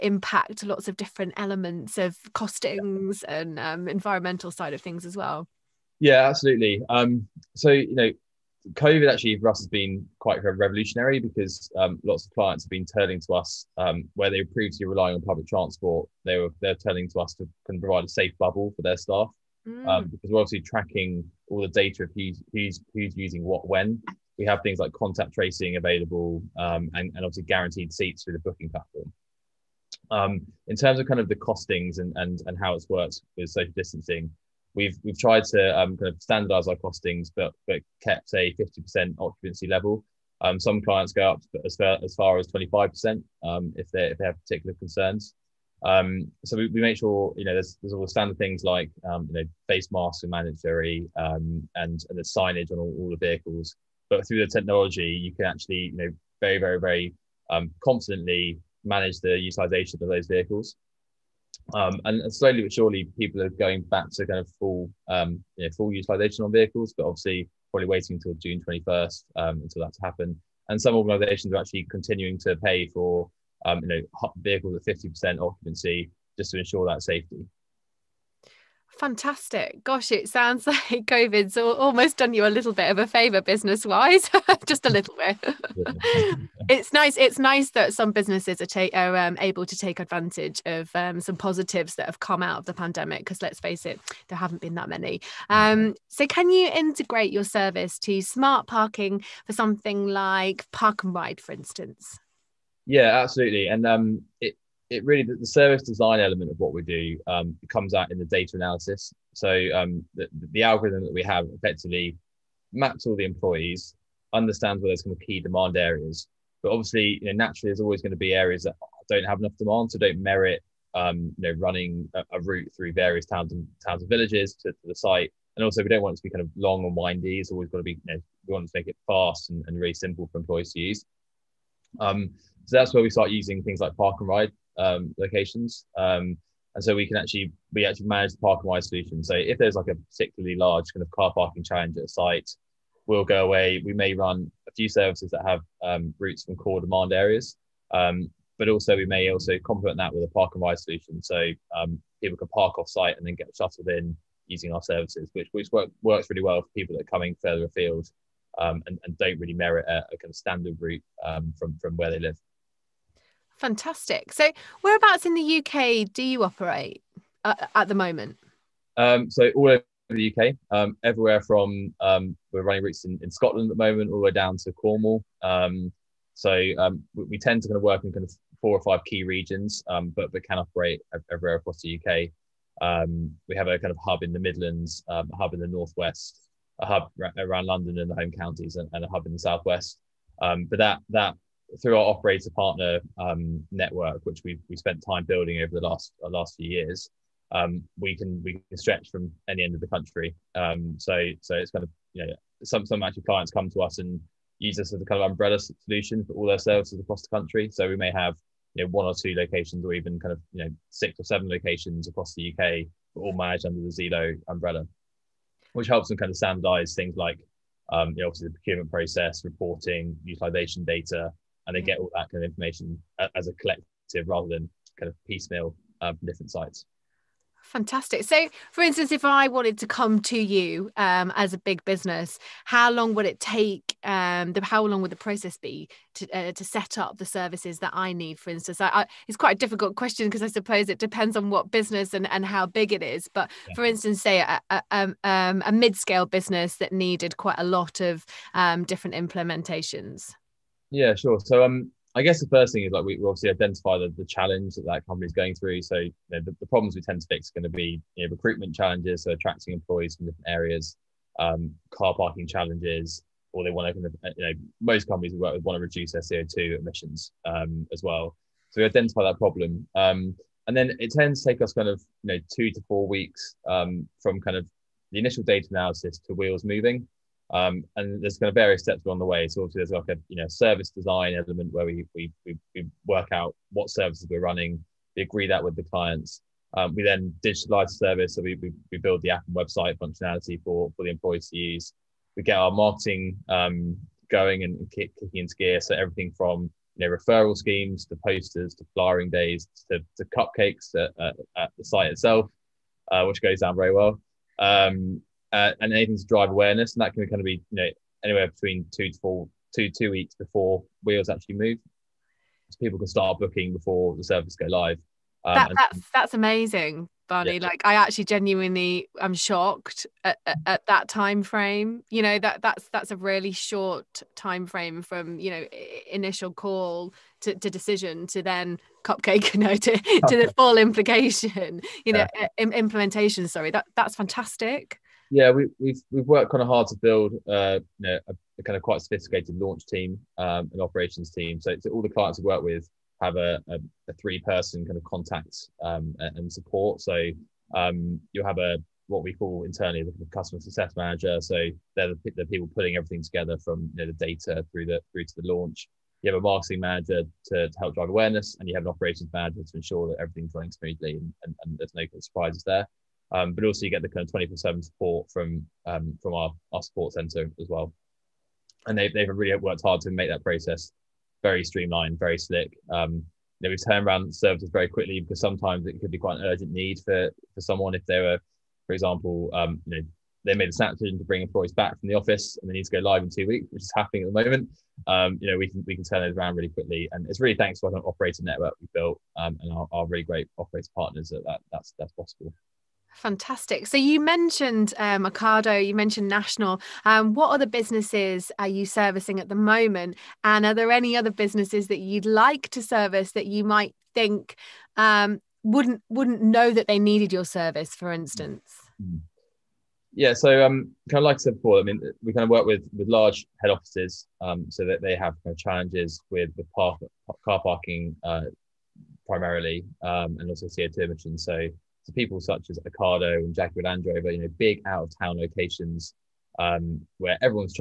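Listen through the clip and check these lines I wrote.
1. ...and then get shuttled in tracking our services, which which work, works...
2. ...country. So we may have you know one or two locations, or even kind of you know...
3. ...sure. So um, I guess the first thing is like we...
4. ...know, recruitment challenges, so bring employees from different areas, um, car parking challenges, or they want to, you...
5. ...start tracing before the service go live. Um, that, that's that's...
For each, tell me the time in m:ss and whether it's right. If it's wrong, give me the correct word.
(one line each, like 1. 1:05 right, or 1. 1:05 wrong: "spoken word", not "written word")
1. 2:33 wrong: "using", not "tracking"
2. 3:27 right
3. 4:11 right
4. 4:18 wrong: "attracting", not "bring"
5. 5:13 wrong: "booking", not "tracing".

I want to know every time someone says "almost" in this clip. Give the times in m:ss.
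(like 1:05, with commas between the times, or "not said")
1:21.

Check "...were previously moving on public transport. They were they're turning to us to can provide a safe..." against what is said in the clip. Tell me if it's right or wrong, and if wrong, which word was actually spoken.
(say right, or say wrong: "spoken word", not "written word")
wrong: "relying", not "moving".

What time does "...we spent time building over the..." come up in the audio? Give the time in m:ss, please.
3:14.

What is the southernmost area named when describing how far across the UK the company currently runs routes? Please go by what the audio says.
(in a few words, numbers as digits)
Cornwall.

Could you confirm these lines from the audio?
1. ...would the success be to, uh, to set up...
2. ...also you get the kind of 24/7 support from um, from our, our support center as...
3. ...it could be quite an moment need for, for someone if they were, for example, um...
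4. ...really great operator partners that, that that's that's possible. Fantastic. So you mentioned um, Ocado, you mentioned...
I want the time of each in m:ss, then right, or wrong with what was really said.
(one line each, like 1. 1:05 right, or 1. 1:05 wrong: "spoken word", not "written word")
1. 3:55 wrong: "process", not "success"
2. 6:03 right
3. 6:15 wrong: "urgent", not "moment"
4. 6:30 right.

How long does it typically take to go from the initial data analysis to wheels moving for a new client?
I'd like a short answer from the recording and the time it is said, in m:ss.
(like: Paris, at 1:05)
2 to 4 weeks, at 4:32.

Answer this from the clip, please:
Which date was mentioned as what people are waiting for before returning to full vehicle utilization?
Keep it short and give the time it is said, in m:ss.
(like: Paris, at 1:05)
June 21st, at 1:08.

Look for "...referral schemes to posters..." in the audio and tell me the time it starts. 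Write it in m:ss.
4:57.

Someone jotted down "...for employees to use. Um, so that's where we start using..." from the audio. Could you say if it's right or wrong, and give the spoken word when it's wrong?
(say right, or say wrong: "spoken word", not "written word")
right.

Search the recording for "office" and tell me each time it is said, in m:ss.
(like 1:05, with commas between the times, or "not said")
6:22, 6:53.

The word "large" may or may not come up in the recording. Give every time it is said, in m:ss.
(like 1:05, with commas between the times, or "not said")
2:20, 6:53.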